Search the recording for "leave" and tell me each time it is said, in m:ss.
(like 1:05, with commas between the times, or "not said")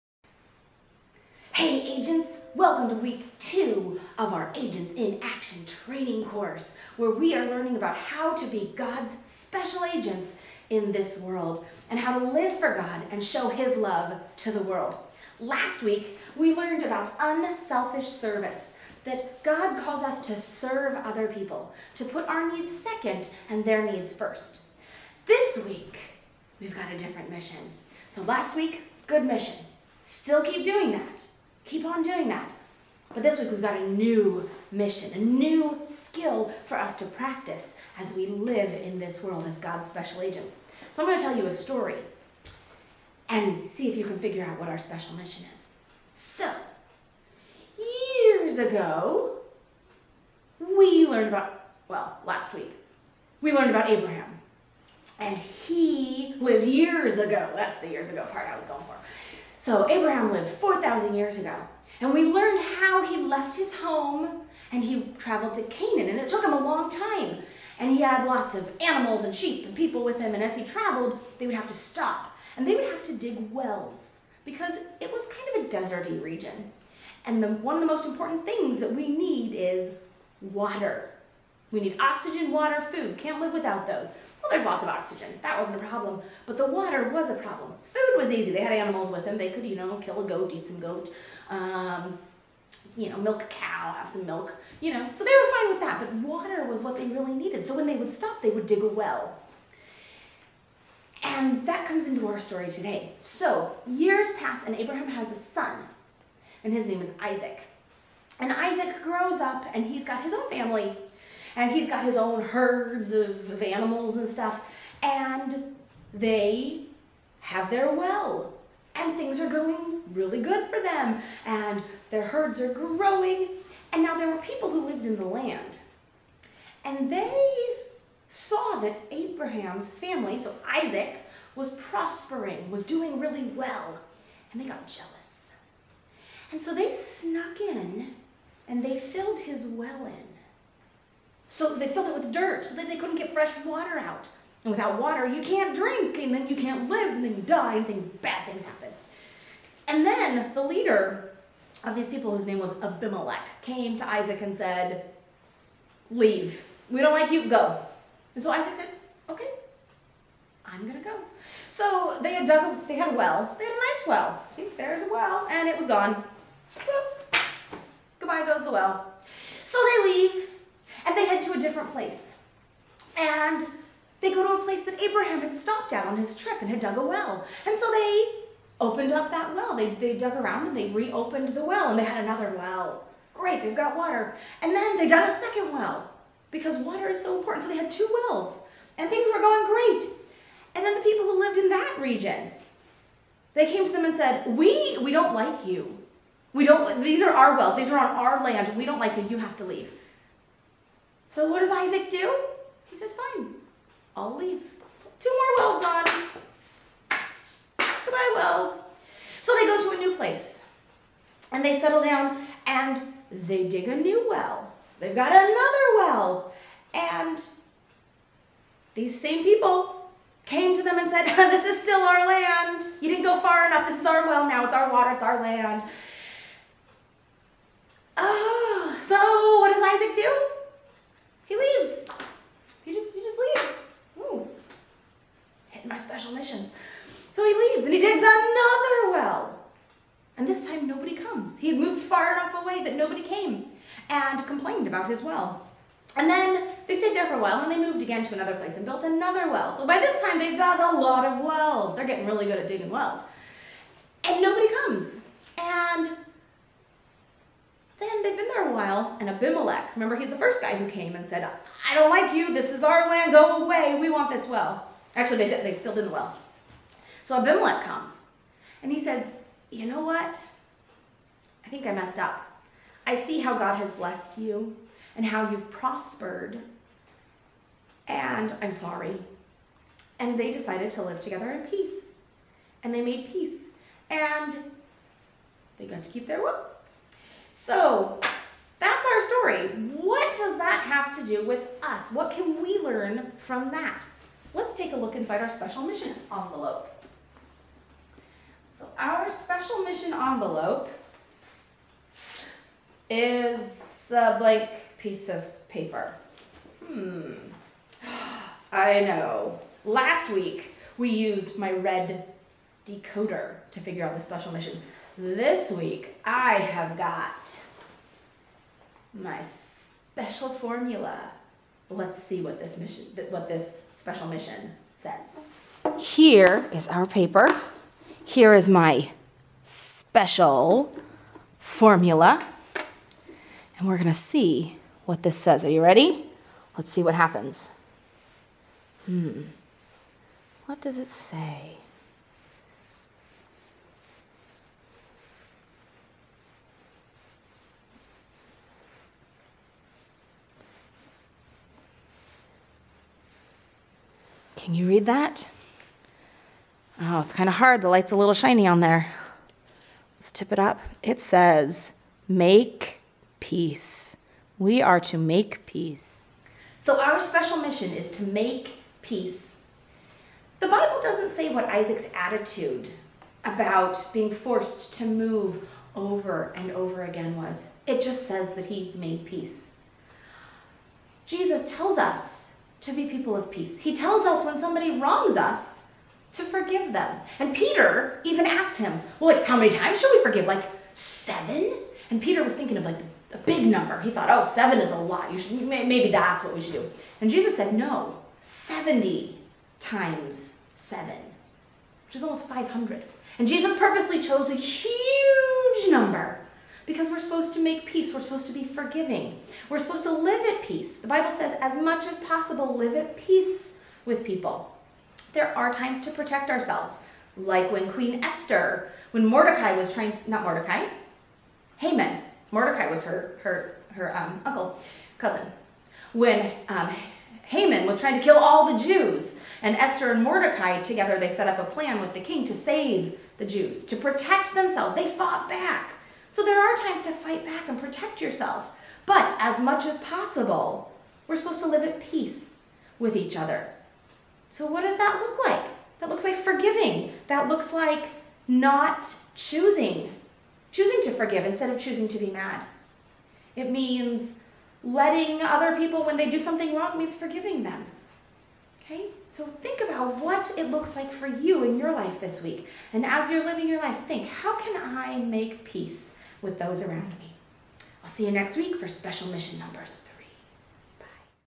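2:36, 2:50, 3:19, 3:24, 3:57.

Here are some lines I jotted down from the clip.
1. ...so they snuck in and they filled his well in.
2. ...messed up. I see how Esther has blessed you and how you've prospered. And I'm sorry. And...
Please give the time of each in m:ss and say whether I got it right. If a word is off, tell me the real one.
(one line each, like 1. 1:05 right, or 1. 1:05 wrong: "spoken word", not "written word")
1. 2:16 right
2. 4:31 wrong: "God", not "Esther".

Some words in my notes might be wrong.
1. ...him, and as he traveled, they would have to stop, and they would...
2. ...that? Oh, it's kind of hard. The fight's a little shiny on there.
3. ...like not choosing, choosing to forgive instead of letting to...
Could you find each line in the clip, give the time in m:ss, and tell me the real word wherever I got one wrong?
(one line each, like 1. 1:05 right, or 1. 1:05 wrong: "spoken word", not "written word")
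1. 1:10 right
2. 5:55 wrong: "light", not "fight"
3. 7:27 wrong: "choosing", not "letting".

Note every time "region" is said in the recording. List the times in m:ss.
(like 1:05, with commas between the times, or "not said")
1:16, 3:11.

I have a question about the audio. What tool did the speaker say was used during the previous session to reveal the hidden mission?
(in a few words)
red decoder.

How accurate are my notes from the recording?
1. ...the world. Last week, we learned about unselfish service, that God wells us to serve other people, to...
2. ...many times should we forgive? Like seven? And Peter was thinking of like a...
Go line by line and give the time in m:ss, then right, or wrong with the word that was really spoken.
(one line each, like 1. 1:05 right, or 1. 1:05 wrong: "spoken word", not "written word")
1. 0:14 wrong: "calls", not "wells"
2. 6:29 right.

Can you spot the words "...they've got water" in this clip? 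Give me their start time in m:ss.
3:03.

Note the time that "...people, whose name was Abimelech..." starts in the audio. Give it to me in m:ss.
2:32.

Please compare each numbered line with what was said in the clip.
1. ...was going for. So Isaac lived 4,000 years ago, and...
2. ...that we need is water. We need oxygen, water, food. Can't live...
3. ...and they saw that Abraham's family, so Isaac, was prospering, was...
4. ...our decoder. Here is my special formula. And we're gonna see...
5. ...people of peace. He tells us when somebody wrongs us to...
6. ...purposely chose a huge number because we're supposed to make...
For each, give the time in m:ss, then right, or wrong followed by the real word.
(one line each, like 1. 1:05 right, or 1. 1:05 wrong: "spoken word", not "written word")
1. 0:58 wrong: "Abraham", not "Isaac"
2. 1:18 right
3. 2:06 right
4. 5:26 wrong: "paper", not "decoder"
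5. 6:23 right
6. 6:43 right.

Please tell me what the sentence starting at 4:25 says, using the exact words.
Actually, they, did, they filled in the well.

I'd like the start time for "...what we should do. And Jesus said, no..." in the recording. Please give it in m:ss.
6:36.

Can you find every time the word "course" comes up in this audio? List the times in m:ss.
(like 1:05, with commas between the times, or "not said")
0:06.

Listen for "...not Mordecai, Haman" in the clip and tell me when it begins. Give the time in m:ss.
7:00.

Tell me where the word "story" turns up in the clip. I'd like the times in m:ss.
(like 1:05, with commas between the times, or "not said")
0:41, 1:42, 4:49.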